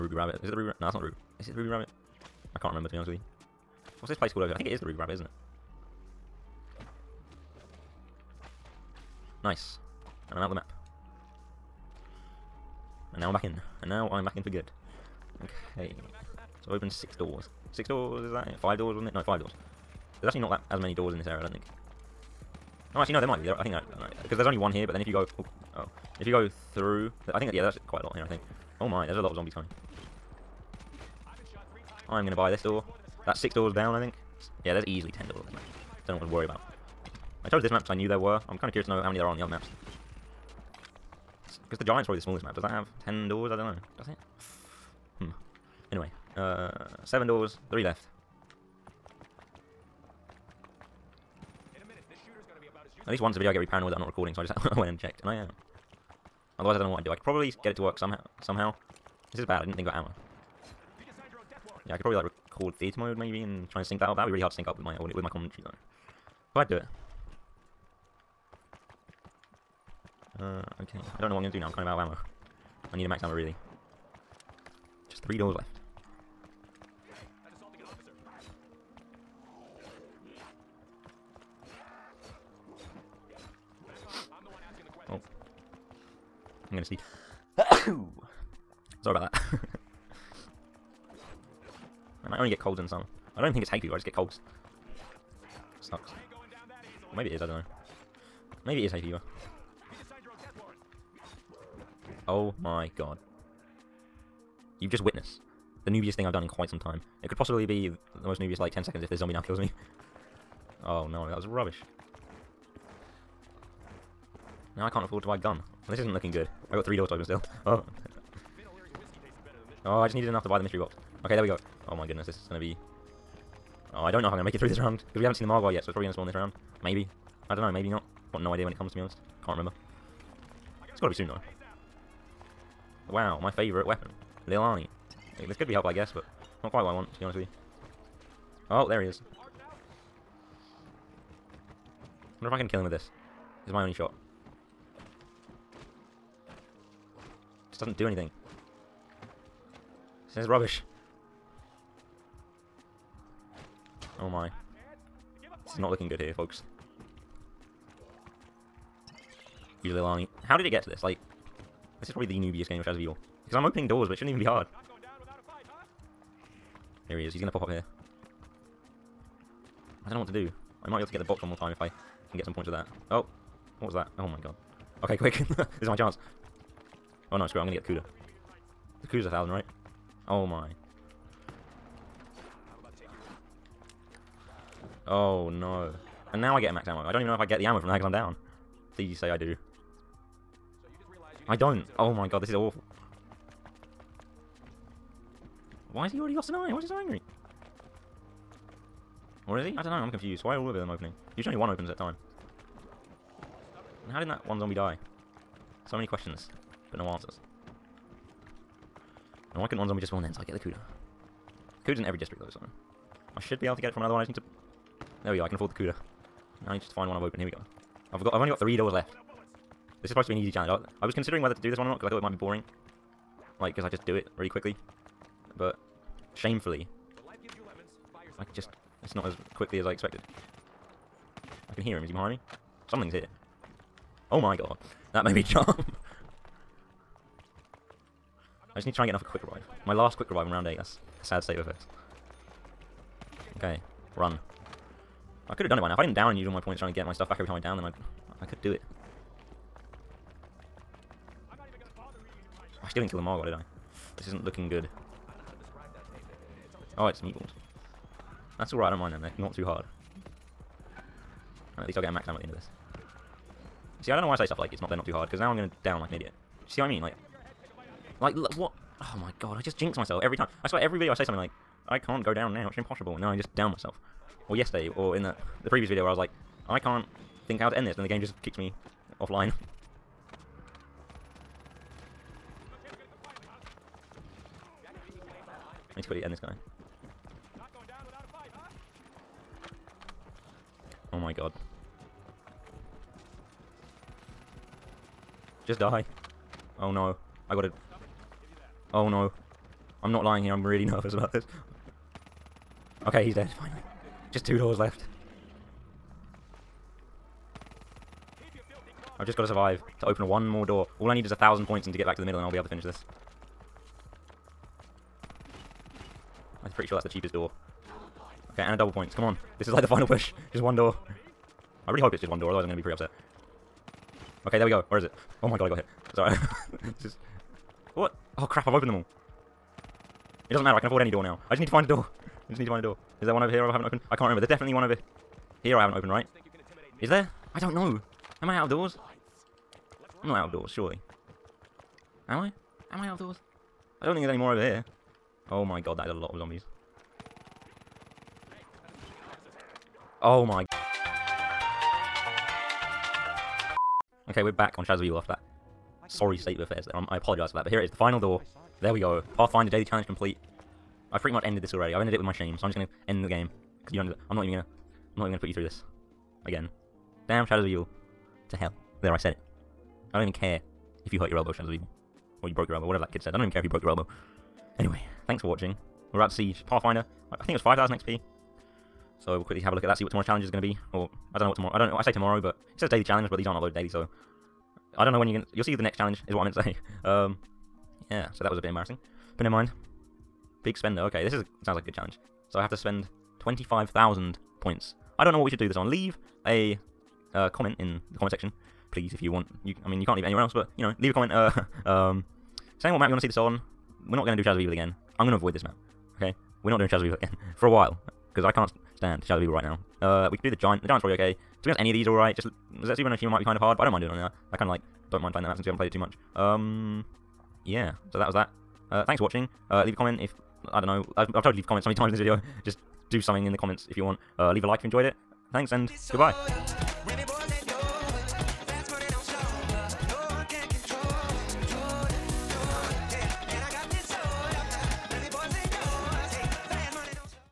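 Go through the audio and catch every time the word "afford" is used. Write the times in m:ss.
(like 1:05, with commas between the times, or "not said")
1:55, 3:35, 5:30.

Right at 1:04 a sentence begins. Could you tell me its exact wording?
That'd be really hard to sync up with my audio, with my commentary though.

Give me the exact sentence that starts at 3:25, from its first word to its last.
So many questions, but no answers.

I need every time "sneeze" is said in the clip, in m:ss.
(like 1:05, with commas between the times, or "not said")
1:26.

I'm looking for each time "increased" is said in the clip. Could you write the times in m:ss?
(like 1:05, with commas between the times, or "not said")
not said.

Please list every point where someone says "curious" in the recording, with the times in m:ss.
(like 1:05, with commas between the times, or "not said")
0:38.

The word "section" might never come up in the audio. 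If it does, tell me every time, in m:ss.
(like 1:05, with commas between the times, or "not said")
6:38.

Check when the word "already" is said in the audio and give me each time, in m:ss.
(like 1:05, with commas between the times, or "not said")
3:16, 6:01.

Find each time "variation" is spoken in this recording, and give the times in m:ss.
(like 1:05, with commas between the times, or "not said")
not said.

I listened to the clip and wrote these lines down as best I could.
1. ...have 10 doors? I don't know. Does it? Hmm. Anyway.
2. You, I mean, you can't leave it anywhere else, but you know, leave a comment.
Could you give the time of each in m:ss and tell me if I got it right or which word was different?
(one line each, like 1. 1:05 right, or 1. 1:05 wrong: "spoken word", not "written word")
1. 0:42 right
2. 6:39 right.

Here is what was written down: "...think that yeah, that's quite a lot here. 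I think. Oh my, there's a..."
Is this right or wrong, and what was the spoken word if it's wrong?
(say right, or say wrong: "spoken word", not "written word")
right.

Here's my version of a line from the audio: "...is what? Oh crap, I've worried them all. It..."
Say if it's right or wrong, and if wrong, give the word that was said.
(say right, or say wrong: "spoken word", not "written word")
wrong: "opened", not "worried".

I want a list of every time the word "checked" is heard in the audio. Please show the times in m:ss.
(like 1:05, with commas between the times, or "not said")
0:54.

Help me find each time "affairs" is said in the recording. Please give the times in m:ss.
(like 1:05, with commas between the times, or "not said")
4:01, 5:56.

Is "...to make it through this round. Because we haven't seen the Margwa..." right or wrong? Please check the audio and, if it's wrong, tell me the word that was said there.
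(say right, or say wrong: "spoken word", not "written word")
right.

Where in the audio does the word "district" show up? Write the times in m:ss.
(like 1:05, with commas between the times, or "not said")
3:32.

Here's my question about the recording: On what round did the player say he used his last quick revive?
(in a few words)
8.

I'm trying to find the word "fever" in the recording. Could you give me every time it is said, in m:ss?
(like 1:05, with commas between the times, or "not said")
1:33, 1:39.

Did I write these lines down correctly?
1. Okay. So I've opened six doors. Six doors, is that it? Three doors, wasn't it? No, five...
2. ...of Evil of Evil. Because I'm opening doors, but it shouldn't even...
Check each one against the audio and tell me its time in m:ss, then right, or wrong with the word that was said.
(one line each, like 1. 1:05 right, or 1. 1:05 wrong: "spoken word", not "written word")
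1. 0:15 wrong: "Five", not "Three"
2. 2:42 wrong: "Shadows", not "Evil".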